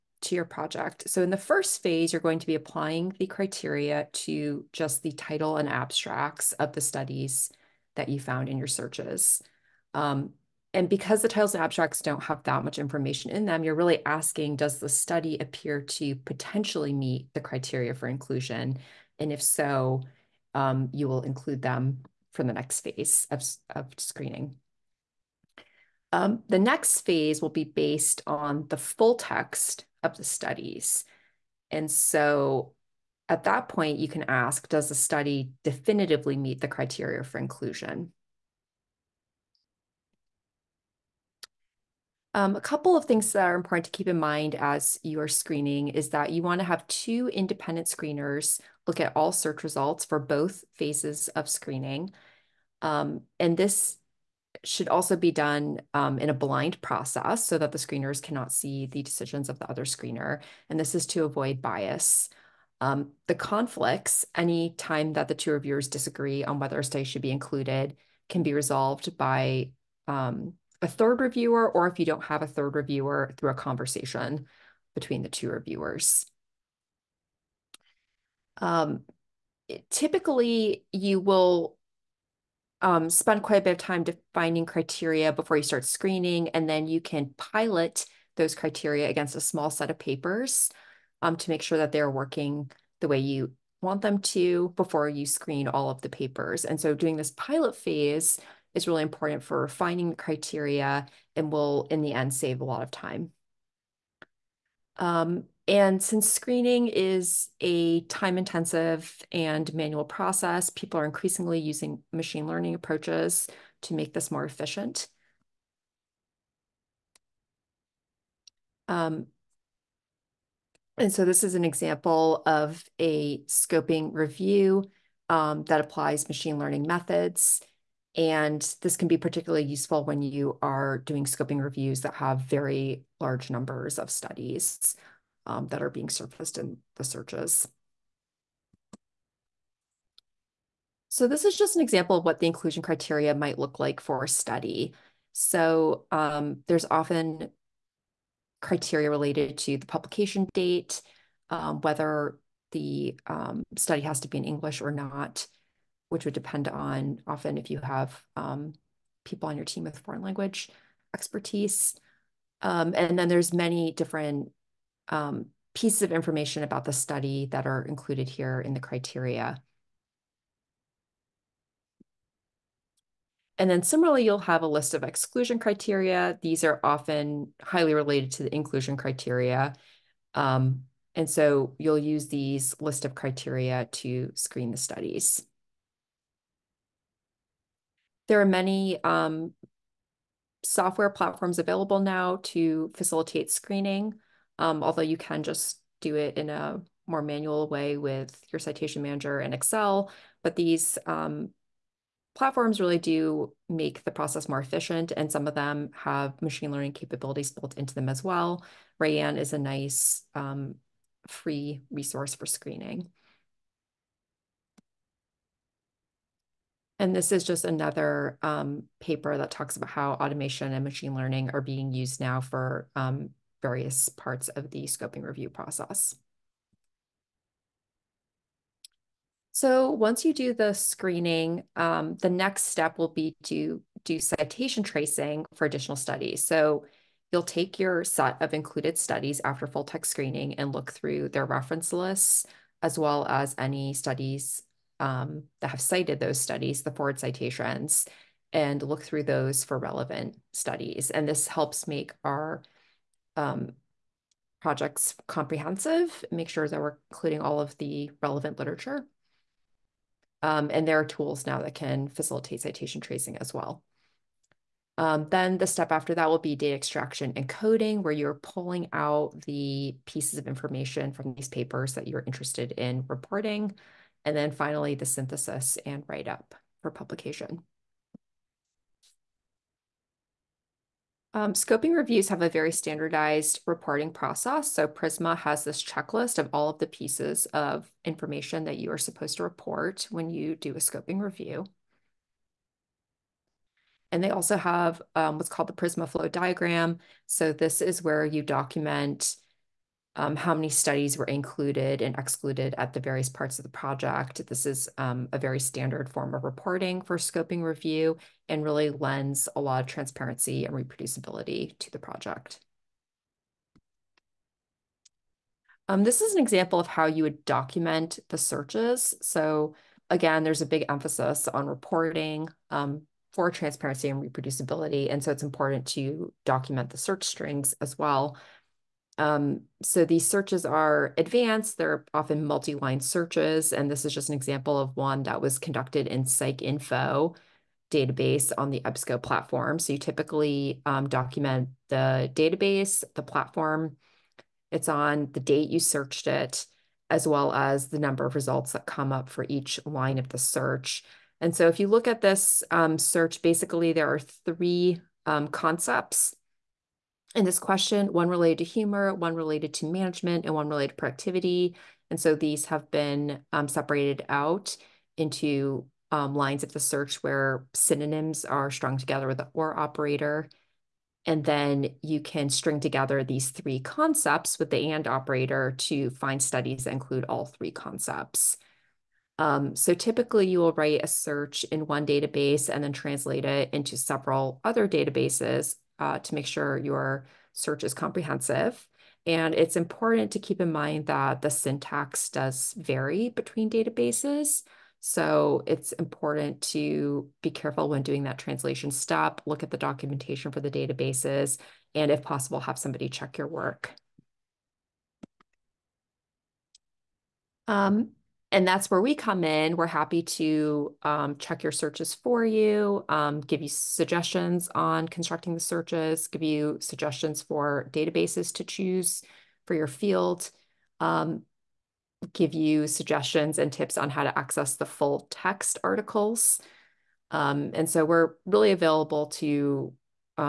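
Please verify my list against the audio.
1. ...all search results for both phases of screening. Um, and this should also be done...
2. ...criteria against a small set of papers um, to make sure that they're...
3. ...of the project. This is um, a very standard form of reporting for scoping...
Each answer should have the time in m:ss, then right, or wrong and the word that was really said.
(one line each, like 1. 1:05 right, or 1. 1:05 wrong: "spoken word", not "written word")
1. 0:49 right
2. 1:28 right
3. 5:03 right.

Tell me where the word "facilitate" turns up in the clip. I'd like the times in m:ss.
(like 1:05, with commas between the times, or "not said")
3:12, 4:22.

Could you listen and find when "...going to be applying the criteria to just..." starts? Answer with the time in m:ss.
0:02.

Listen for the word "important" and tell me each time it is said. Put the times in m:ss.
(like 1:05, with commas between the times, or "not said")
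0:43, 1:39, 5:25, 6:29, 6:35.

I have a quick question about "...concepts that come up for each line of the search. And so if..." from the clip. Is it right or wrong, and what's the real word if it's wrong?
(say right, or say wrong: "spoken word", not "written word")
wrong: "results", not "concepts".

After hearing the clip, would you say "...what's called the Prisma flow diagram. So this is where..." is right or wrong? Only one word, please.
right.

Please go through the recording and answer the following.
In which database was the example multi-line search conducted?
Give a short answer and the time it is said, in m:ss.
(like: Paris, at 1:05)
PsycInfo, at 5:36.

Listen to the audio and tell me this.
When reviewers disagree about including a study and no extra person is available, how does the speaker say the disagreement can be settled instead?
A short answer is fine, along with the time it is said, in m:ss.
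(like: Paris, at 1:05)
A conversation between the two reviewers, at 1:13.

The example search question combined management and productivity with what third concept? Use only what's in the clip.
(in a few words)
Humor.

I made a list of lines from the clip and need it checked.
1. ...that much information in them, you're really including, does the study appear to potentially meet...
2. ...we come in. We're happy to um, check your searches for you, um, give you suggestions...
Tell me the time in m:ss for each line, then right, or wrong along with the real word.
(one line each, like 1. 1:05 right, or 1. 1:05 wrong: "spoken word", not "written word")
1. 0:12 wrong: "asking", not "including"
2. 6:49 right.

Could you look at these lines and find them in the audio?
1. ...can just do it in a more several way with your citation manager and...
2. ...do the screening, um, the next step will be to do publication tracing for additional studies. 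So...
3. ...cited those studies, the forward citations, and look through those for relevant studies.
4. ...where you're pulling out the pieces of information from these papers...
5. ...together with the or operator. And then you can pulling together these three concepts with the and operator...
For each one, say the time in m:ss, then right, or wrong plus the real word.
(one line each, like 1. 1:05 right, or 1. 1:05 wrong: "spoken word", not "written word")
1. 3:15 wrong: "manual", not "several"
2. 3:50 wrong: "citation", not "publication"
3. 4:05 right
4. 4:28 right
5. 6:08 wrong: "string", not "pulling".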